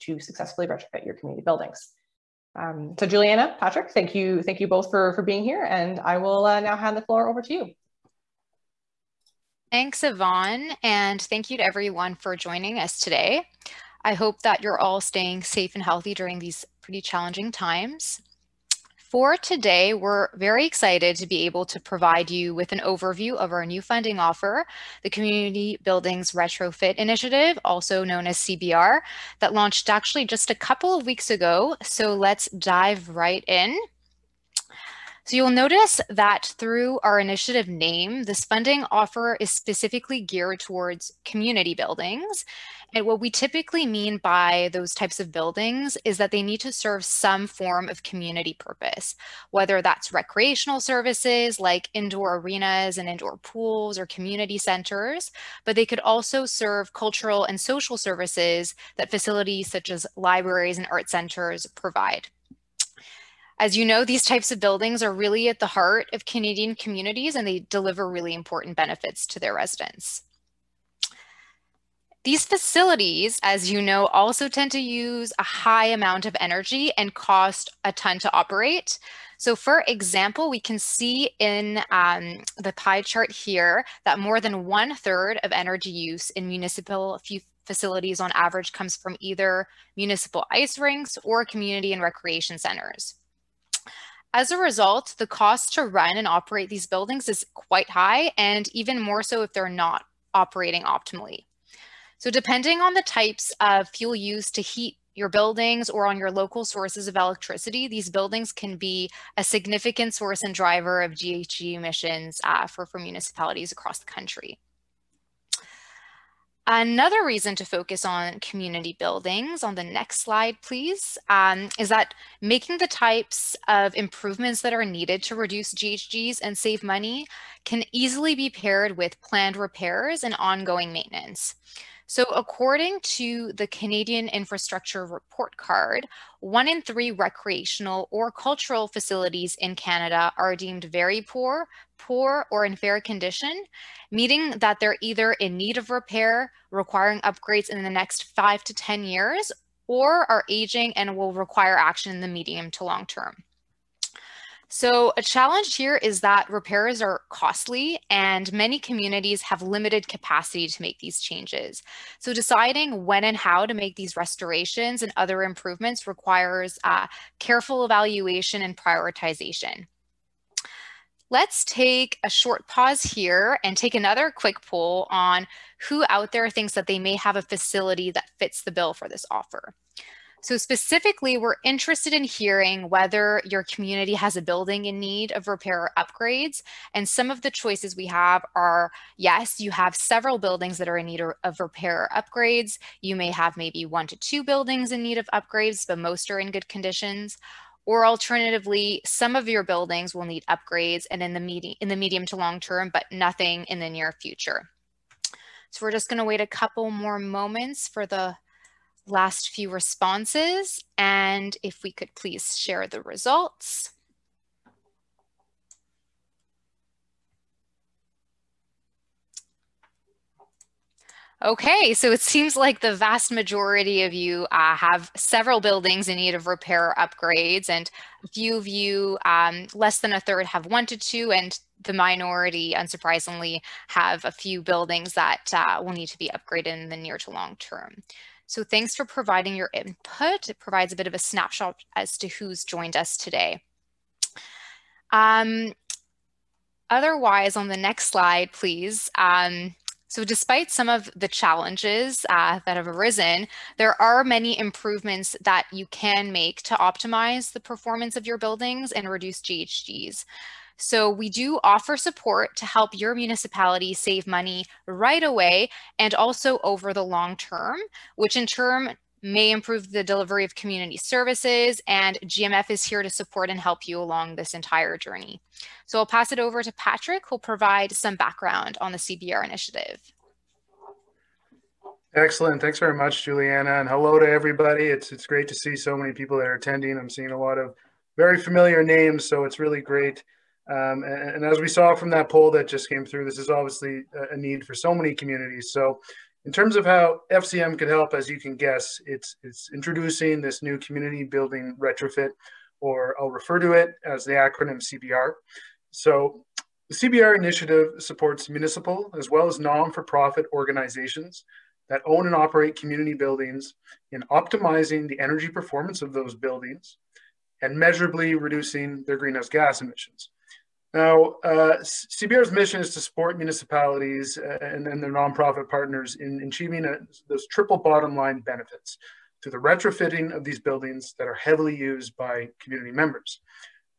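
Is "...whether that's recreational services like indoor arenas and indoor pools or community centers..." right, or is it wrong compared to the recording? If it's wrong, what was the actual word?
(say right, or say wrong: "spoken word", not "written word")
right.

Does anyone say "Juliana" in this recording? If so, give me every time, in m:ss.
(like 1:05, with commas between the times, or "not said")
0:03, 4:43.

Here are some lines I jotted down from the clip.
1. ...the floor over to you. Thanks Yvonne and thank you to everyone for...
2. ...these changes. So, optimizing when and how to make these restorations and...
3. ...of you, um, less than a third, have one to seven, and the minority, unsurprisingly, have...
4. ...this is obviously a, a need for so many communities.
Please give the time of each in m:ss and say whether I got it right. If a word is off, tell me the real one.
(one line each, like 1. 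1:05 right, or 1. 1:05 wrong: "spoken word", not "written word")
1. 0:06 right
2. 2:40 wrong: "deciding", not "optimizing"
3. 3:48 wrong: "two", not "seven"
4. 4:53 right.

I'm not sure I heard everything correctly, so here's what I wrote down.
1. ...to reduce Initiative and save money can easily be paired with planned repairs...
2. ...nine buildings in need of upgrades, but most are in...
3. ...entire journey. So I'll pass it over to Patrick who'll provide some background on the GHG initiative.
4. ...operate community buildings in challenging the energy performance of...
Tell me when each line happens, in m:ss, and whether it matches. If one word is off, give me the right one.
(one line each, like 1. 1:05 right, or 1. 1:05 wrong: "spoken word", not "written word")
1. 2:05 wrong: "GHGs", not "Initiative"
2. 3:14 wrong: "two", not "nine"
3. 4:34 wrong: "CBR", not "GHG"
4. 5:12 wrong: "optimizing", not "challenging".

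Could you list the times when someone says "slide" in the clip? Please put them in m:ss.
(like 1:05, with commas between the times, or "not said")
2:00, 4:08.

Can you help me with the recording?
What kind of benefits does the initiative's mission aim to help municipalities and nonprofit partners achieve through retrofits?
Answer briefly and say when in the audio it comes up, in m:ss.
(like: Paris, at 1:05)
Triple bottom line, at 5:27.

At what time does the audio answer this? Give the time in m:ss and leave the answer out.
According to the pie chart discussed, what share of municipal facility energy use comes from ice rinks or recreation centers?
1:24.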